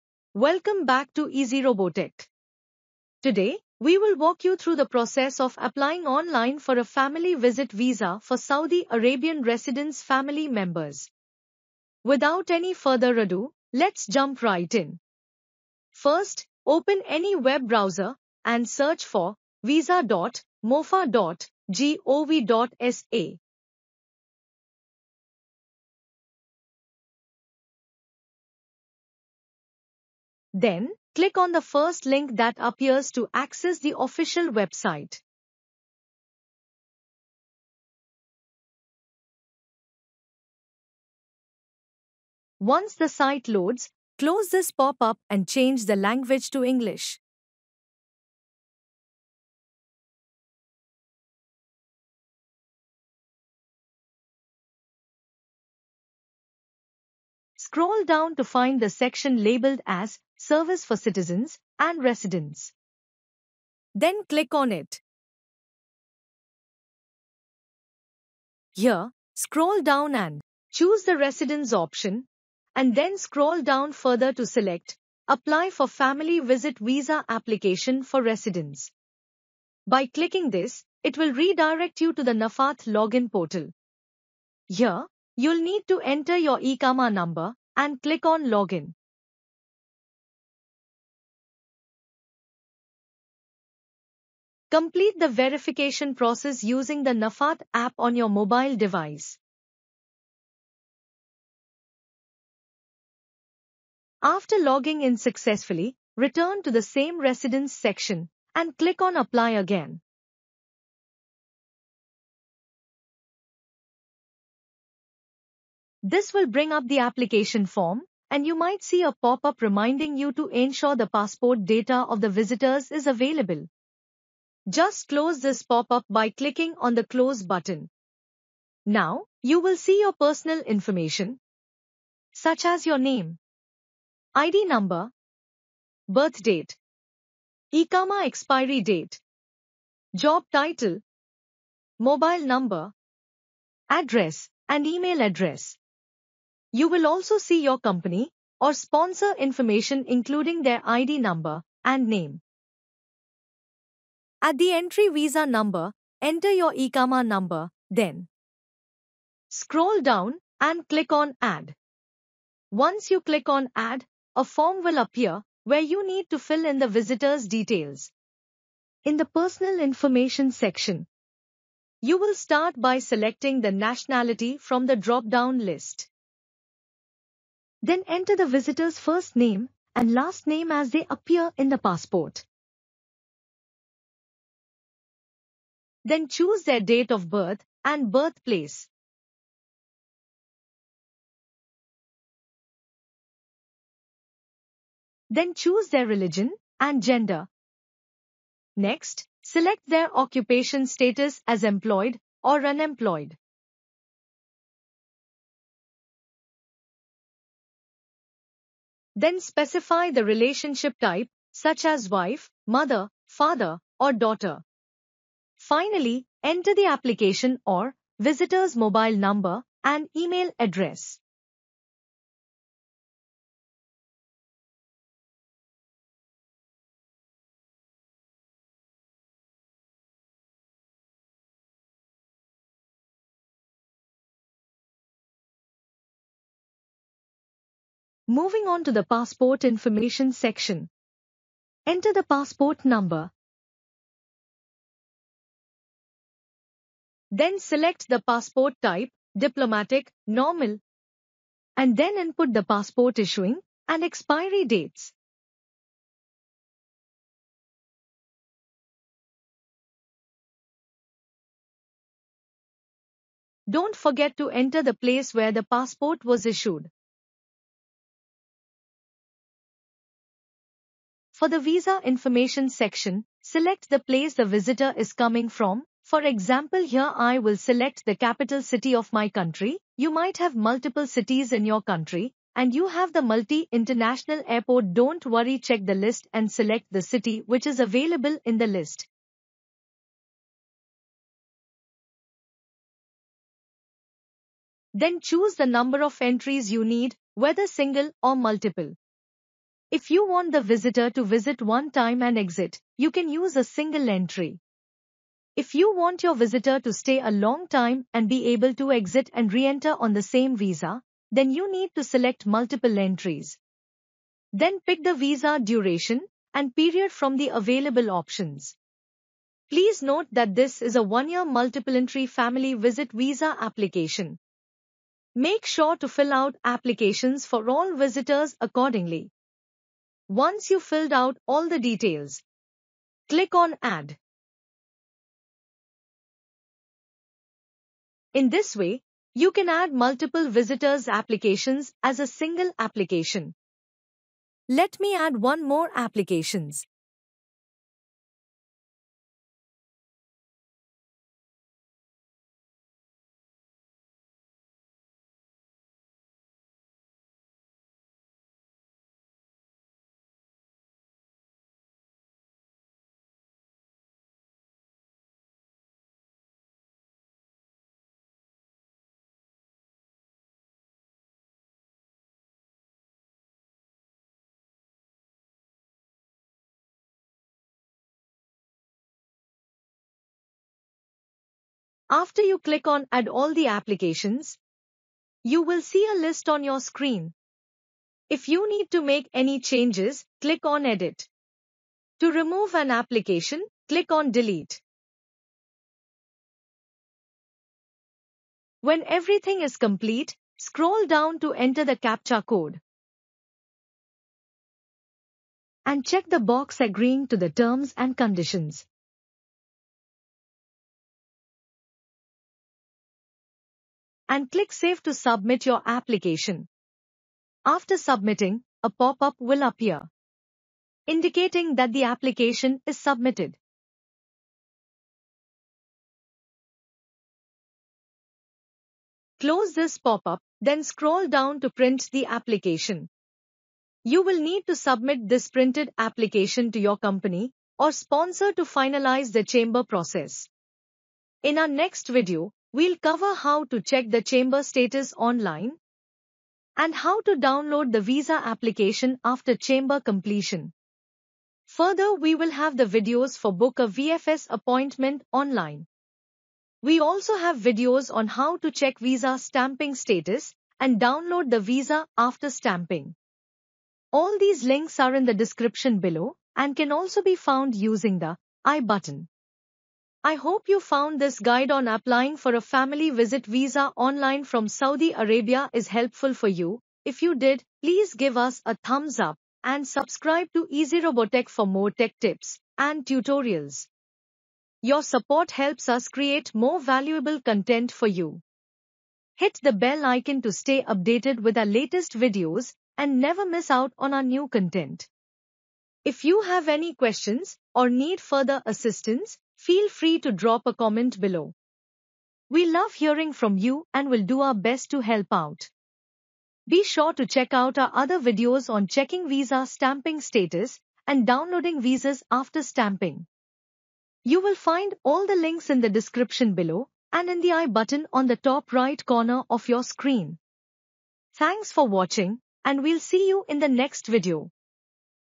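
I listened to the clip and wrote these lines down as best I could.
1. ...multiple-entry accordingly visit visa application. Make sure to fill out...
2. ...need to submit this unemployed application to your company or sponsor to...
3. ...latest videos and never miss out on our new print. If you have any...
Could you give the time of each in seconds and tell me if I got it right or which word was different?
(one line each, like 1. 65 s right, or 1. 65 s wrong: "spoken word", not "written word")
1. 321 s wrong: "family", not "accordingly"
2. 434 s wrong: "printed", not "unemployed"
3. 491 s wrong: "content", not "print".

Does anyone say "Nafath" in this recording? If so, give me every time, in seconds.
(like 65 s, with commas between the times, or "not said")
82 s, 97 s.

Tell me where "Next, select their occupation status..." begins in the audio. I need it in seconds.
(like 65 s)
198 s.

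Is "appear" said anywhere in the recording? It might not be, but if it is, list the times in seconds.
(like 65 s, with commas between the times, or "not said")
32 s, 164 s, 181 s, 419 s.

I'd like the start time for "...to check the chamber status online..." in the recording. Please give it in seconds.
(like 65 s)
443 s.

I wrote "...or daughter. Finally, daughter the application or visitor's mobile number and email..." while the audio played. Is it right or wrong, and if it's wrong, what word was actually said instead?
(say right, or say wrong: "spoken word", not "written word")
wrong: "enter", not "daughter".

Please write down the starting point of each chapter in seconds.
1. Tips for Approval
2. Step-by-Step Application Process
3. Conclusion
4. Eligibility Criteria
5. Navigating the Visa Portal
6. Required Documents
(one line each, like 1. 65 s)
1. 360 s
2. 330 s
3. 463 s
4. 80 s
5. 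240 s
6. 190 s.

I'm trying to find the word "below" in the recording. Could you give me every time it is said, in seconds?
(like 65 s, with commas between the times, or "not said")
465 s, 501 s, 516 s.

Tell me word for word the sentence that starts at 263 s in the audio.
Don't forget to enter the place where the passport was issued.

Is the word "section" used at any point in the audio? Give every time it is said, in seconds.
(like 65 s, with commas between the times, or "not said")
58 s, 107 s, 170 s, 240 s, 272 s.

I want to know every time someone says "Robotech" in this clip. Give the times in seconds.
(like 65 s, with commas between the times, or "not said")
1 s, 481 s.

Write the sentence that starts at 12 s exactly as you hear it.
Without any further ado, let's jump right in.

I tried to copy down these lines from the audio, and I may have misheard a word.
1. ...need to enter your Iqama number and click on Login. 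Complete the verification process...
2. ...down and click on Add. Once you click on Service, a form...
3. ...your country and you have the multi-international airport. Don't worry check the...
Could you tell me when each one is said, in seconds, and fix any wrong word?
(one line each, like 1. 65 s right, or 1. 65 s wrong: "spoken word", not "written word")
1. 85 s right
2. 160 s wrong: "Add", not "Service"
3. 281 s right.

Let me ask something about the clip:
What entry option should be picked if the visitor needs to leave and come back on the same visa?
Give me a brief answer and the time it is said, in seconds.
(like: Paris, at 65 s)
Multiple entries, at 312 s.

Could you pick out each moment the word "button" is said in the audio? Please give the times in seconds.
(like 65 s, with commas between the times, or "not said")
127 s, 468 s, 517 s.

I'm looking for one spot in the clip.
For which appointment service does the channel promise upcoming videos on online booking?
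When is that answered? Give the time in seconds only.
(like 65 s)
453 s.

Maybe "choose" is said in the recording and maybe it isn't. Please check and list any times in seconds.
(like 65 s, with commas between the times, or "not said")
70 s, 186 s, 195 s, 295 s.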